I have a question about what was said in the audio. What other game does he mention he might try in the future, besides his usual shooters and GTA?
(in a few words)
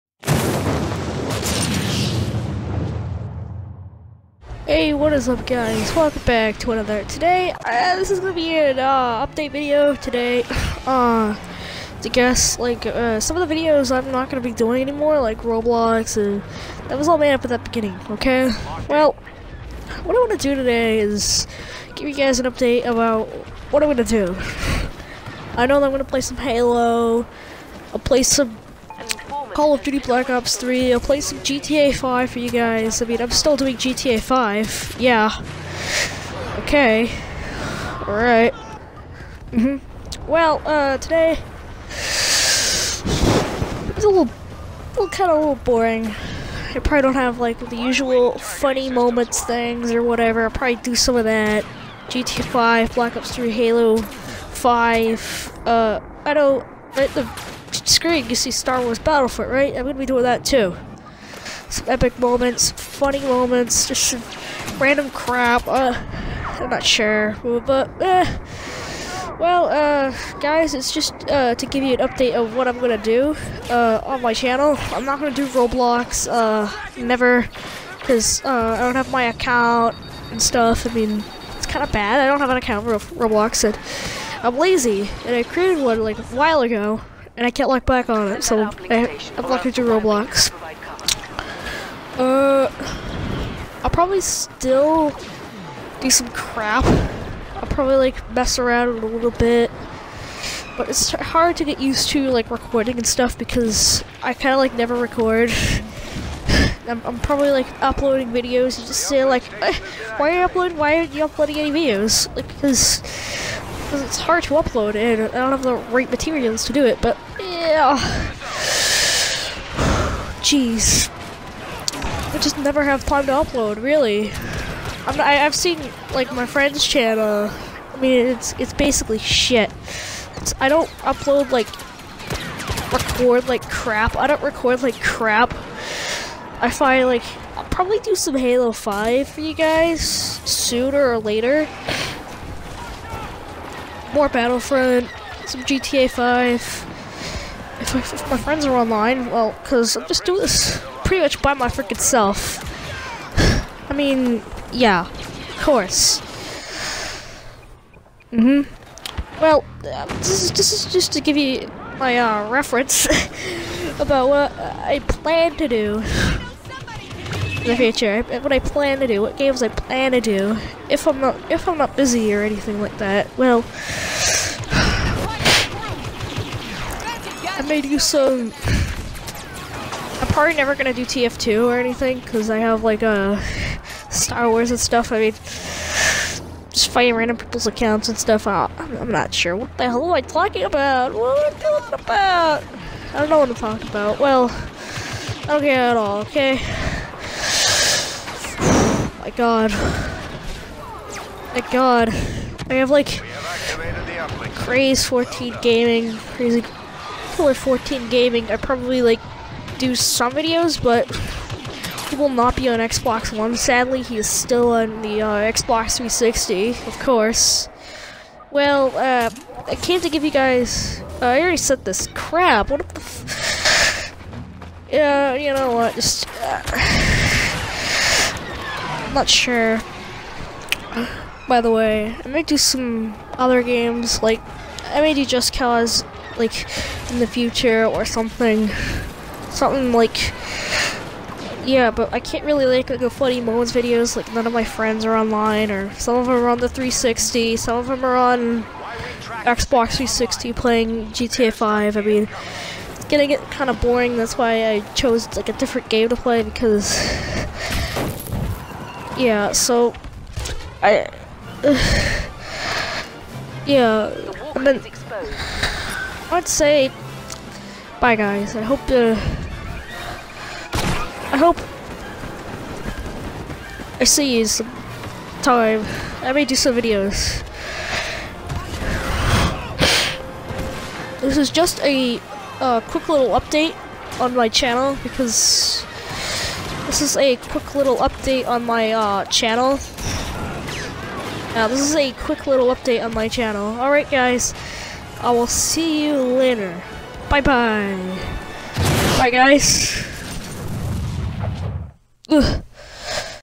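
Just Cause.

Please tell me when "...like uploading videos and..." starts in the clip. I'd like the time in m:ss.
1:47.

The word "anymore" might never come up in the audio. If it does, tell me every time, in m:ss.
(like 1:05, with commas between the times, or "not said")
0:14.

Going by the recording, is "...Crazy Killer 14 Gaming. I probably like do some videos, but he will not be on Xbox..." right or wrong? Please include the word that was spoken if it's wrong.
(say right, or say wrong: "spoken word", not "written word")
right.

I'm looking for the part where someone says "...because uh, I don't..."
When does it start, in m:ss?
1:17.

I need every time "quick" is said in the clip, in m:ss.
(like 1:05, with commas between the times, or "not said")
4:42, 4:47, 4:52.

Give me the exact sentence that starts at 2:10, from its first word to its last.
It's, I don't upload, like, record like crap.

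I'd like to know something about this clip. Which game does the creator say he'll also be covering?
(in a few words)
Star Wars Battlefront.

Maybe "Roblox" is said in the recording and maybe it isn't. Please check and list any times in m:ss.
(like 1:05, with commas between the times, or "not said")
0:15, 1:15, 1:23, 1:29.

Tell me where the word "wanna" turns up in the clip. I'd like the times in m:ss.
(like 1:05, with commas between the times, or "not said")
0:20.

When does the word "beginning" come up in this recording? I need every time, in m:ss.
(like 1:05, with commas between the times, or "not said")
0:17.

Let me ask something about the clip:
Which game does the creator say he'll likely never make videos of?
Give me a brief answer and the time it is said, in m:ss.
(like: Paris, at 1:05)
TF2, at 3:01.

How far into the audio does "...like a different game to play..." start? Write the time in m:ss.
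4:15.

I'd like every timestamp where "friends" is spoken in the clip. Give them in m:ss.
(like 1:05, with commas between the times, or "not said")
2:06, 2:28, 4:04.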